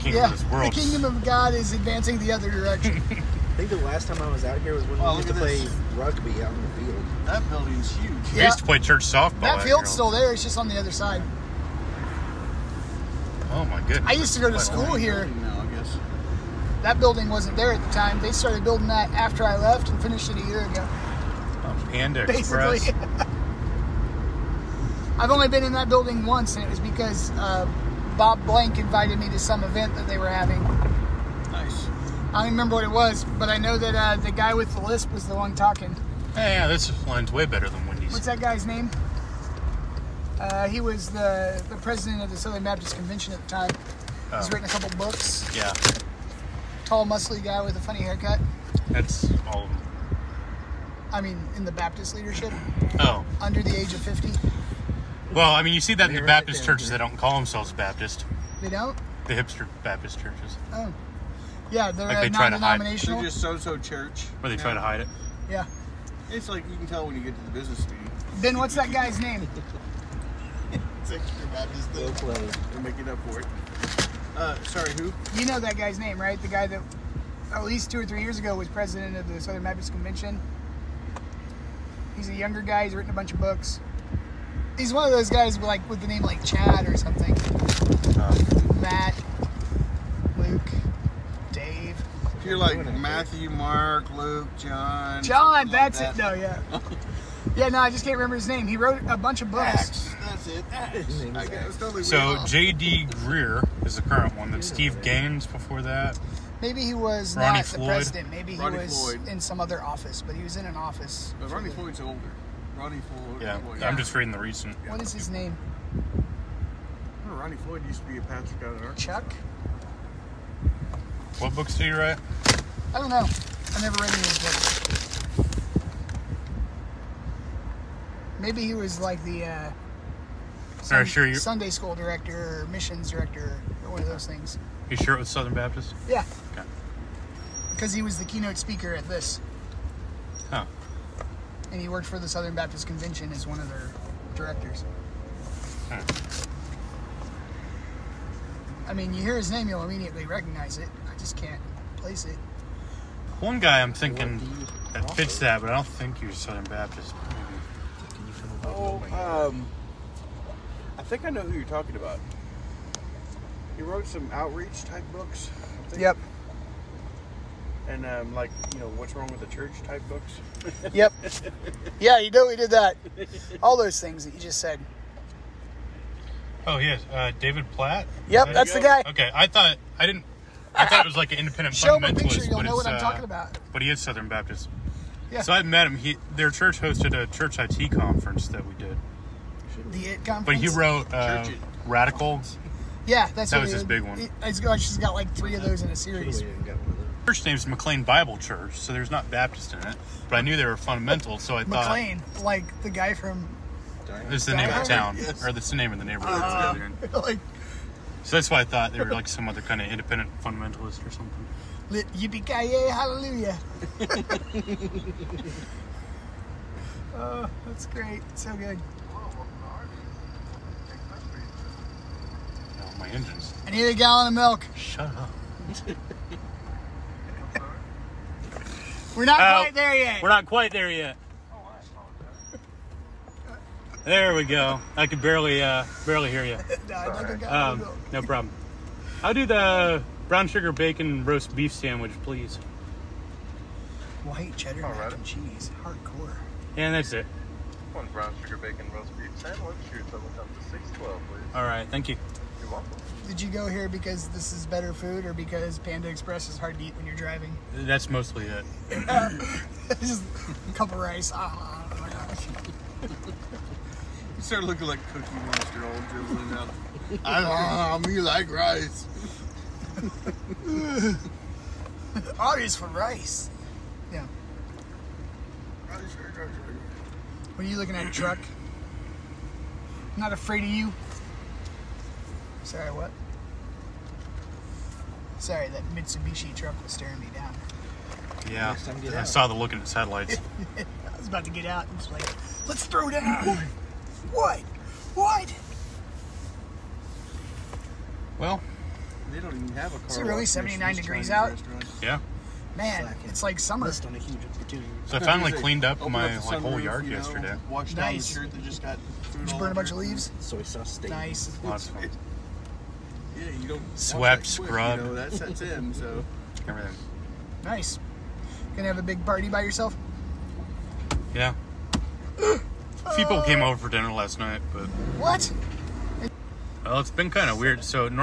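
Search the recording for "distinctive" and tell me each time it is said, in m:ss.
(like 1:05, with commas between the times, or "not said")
not said.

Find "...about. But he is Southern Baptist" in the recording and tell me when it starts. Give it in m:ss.
3:03.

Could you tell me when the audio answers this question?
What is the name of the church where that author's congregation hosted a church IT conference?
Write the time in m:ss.
3:17.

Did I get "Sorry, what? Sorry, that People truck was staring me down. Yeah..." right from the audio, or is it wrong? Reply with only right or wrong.
wrong.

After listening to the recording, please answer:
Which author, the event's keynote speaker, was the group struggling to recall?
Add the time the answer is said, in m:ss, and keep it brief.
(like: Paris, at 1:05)
David Platt, at 2:57.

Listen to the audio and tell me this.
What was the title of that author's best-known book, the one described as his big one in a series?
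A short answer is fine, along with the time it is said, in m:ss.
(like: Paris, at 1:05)
Radical, at 3:11.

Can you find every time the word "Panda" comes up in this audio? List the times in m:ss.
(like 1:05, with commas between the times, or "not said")
0:21, 4:15.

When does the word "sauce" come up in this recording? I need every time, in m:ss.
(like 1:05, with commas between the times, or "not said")
5:10.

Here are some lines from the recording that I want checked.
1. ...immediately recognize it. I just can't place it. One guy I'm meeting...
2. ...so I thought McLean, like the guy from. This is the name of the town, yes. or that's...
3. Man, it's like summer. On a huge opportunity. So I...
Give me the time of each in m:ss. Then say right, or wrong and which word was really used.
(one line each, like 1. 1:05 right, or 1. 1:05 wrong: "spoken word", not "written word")
1. 2:29 wrong: "thinking", not "meeting"
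2. 3:21 right
3. 5:02 right.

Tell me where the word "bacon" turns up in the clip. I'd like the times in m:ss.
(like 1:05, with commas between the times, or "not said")
4:00, 4:08.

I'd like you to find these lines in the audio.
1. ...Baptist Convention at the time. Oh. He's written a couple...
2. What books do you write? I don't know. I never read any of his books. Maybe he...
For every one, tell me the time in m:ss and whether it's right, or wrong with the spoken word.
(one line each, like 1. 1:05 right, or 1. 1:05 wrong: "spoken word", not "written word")
1. 0:42 right
2. 2:01 right.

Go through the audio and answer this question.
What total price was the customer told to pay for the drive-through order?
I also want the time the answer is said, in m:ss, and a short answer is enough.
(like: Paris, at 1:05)
$6.12, at 4:10.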